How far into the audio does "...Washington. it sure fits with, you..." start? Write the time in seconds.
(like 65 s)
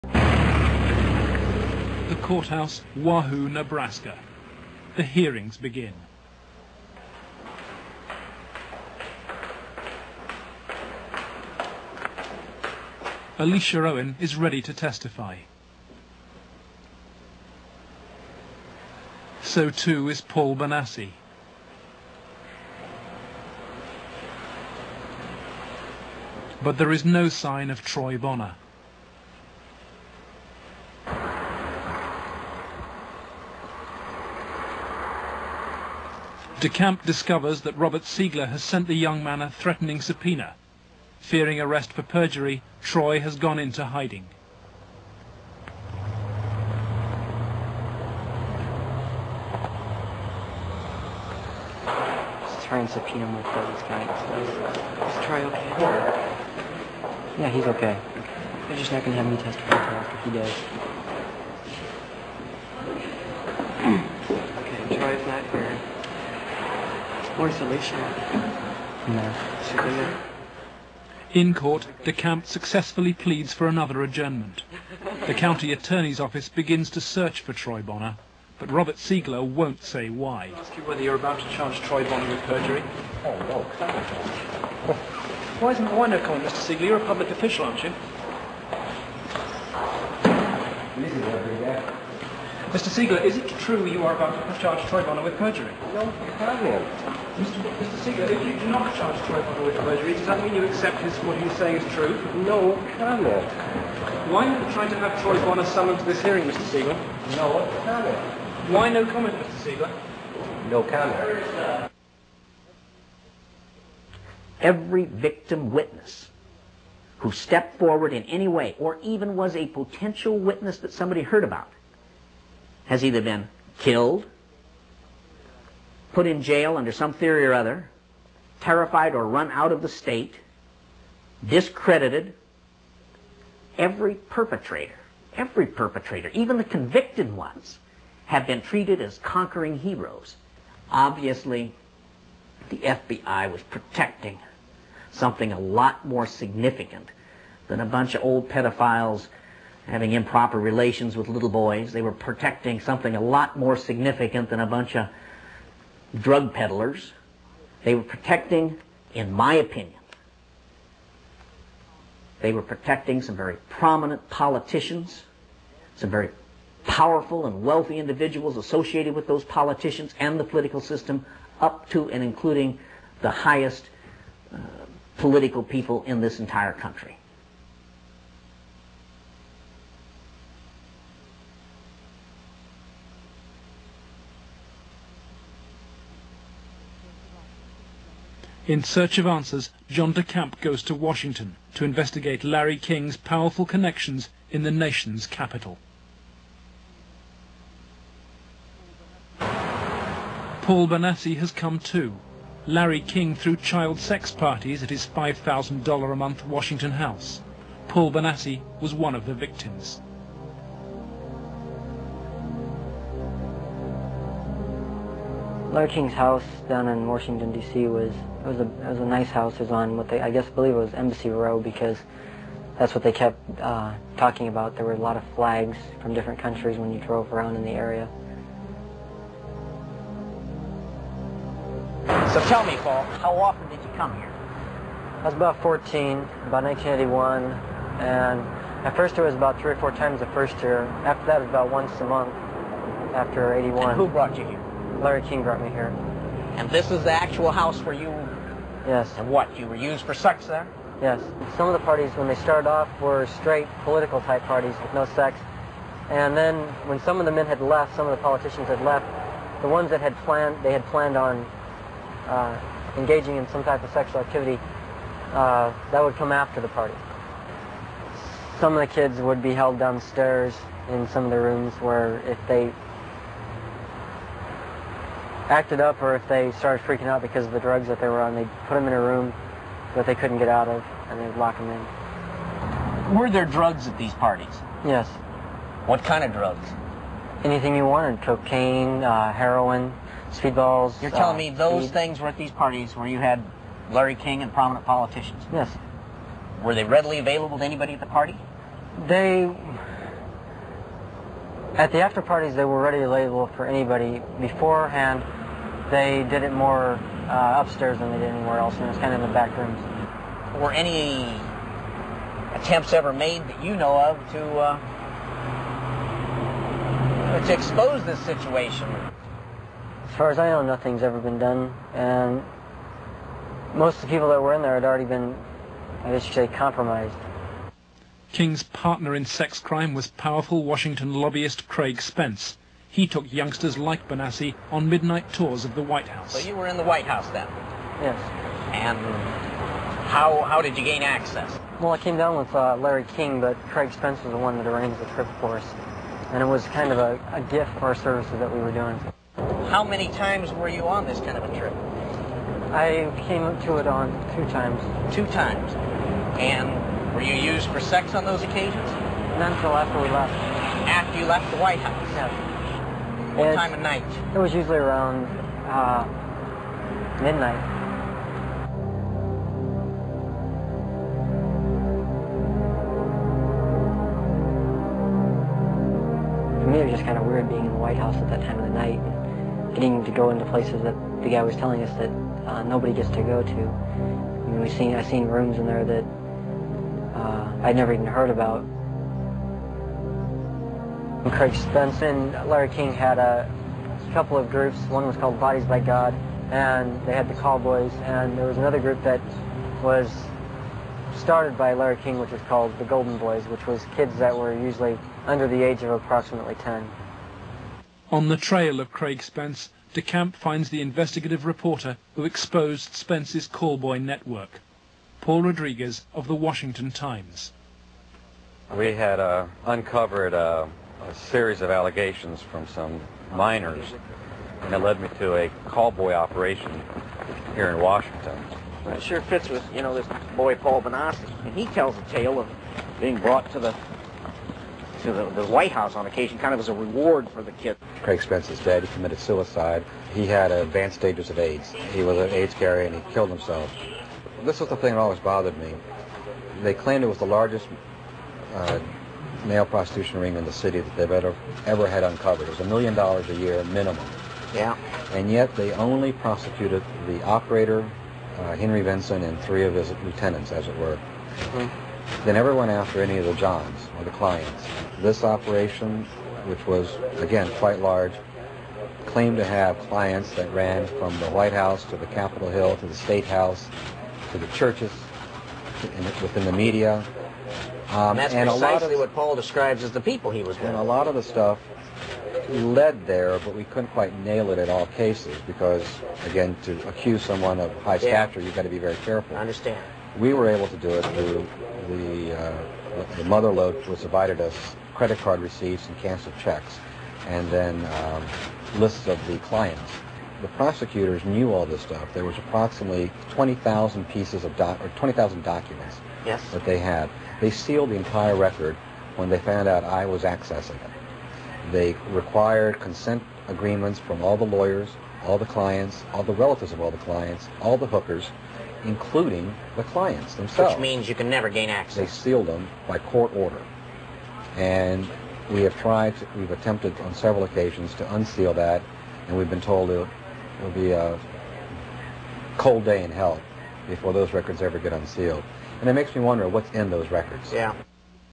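427 s.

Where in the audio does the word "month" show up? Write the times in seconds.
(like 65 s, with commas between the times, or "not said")
206 s, 242 s.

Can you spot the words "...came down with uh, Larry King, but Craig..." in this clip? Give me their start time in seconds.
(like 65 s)
341 s.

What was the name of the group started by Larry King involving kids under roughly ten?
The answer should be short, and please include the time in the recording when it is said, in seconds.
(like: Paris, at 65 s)
Golden Boys, at 402 s.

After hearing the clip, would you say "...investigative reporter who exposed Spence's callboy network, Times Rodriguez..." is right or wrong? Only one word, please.
wrong.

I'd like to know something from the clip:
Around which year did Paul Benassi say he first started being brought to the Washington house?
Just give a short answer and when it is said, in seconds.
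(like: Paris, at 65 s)
1981, at 236 s.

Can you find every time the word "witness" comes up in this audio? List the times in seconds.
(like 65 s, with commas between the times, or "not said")
115 s, 120 s.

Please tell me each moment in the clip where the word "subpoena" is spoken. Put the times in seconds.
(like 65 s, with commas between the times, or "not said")
39 s, 52 s.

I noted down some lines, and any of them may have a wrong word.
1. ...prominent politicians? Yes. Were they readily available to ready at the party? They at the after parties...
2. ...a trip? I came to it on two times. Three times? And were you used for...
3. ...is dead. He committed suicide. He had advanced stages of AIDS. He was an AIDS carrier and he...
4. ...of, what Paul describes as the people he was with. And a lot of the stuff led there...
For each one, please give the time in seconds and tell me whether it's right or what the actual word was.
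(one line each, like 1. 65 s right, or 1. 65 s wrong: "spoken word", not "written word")
1. 294 s wrong: "anybody", not "ready"
2. 351 s wrong: "Two", not "Three"
3. 438 s right
4. 478 s right.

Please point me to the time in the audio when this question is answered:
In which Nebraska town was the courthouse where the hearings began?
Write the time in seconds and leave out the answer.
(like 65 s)
2 s.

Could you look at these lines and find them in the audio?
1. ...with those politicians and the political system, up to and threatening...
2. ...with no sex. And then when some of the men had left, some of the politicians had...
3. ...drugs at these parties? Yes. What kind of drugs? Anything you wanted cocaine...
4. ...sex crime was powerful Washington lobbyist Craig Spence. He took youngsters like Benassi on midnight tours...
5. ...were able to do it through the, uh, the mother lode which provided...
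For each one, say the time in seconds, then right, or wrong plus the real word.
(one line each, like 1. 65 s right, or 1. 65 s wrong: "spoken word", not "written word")
1. 169 s wrong: "including", not "threatening"
2. 254 s right
3. 283 s right
4. 329 s right
5. 490 s right.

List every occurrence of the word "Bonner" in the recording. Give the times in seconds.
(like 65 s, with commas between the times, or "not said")
28 s, 77 s, 82 s, 95 s, 105 s.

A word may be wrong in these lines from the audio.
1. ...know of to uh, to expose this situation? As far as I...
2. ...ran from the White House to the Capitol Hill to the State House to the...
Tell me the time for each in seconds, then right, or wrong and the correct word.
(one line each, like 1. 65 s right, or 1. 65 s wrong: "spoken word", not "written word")
1. 313 s right
2. 470 s right.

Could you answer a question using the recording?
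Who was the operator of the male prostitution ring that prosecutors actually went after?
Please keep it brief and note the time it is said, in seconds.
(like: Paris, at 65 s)
Henry Vinson, at 458 s.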